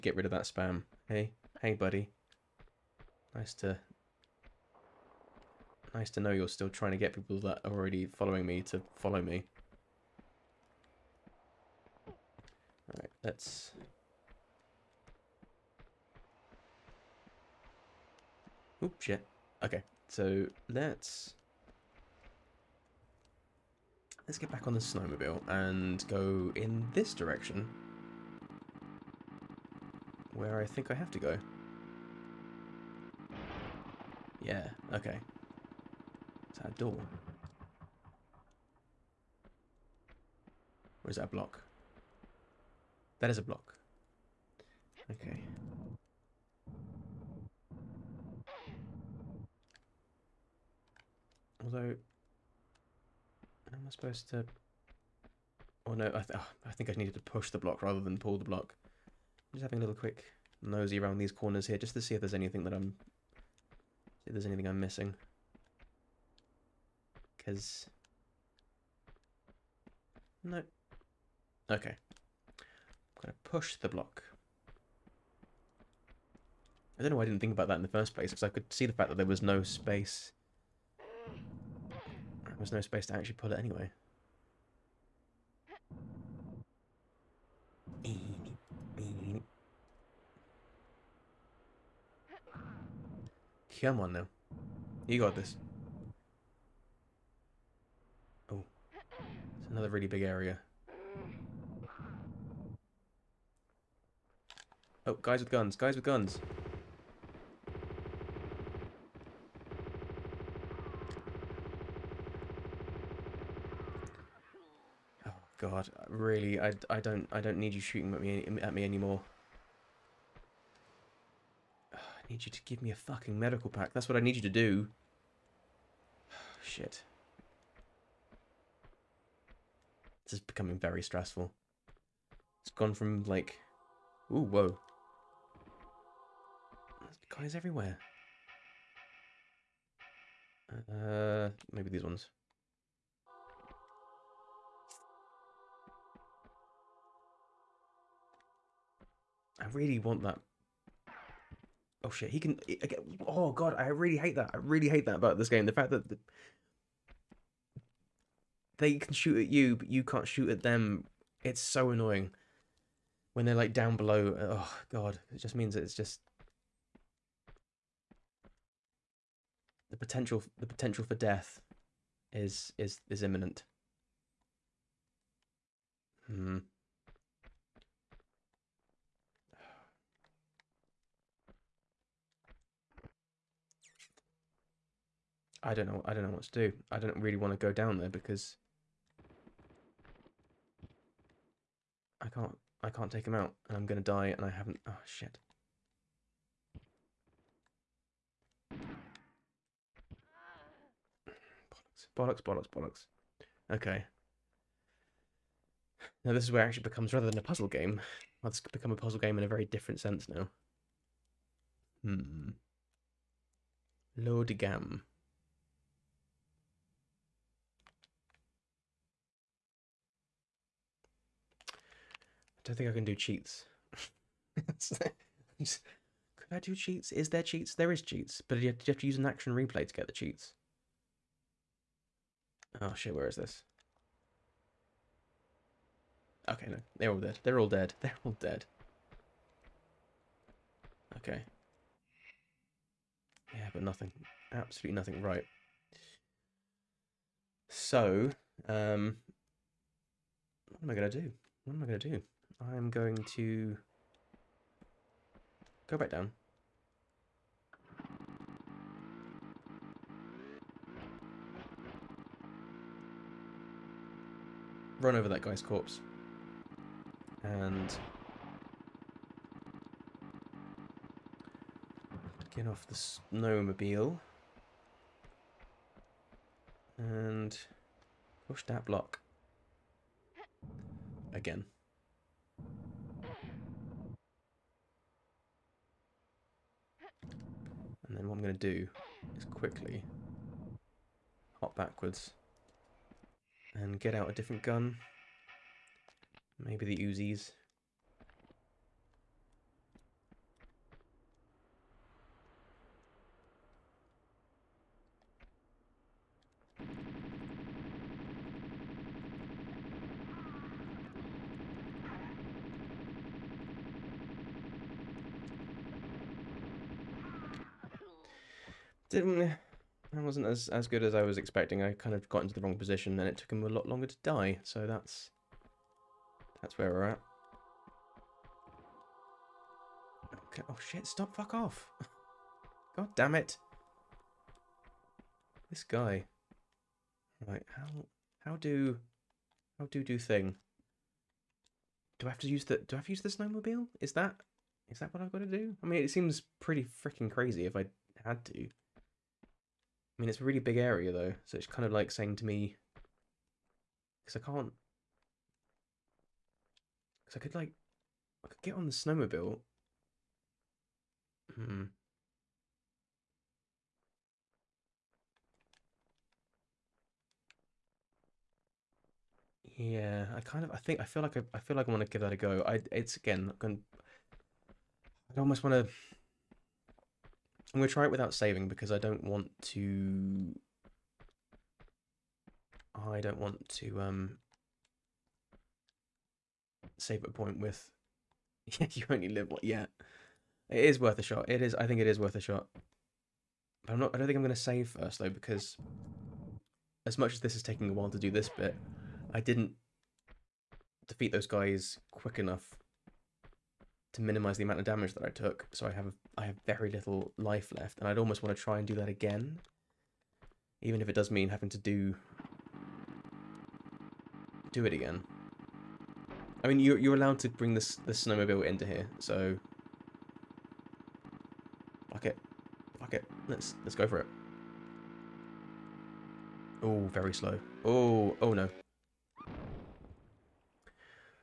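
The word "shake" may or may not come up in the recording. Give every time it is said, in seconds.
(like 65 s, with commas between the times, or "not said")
not said.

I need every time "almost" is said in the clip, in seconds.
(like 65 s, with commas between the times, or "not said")
375 s, 408 s.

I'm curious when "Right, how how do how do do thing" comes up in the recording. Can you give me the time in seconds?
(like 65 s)
337 s.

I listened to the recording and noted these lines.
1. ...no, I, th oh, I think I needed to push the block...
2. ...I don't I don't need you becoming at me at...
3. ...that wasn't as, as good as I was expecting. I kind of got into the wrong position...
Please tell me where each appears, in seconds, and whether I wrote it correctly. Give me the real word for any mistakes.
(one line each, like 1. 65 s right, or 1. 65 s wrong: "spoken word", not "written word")
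1. 55 s right
2. 116 s wrong: "shooting", not "becoming"
3. 319 s right.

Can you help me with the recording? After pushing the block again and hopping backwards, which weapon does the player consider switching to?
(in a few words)
Uzis.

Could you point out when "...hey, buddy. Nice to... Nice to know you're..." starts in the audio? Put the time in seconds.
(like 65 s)
1 s.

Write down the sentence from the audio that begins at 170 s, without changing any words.
The potential for death is is is imminent.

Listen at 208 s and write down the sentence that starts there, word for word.
Well, it's become a puzzle game in a very different sense now.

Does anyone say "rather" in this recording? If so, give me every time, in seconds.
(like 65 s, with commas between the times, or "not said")
57 s, 207 s.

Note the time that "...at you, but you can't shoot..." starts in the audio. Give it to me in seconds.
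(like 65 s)
159 s.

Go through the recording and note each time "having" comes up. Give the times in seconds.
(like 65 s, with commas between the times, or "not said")
59 s, 411 s.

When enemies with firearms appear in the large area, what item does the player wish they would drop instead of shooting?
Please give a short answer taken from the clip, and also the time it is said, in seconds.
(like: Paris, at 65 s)
medical pack, at 123 s.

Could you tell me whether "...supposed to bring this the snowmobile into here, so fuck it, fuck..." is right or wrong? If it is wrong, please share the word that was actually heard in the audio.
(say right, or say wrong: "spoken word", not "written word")
wrong: "allowed", not "supposed".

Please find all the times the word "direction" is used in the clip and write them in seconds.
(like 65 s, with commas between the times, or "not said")
27 s.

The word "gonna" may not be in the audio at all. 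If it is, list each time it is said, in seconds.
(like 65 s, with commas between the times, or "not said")
73 s, 193 s, 373 s.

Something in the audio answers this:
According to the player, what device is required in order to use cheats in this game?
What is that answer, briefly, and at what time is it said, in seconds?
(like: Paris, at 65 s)
action replay, at 229 s.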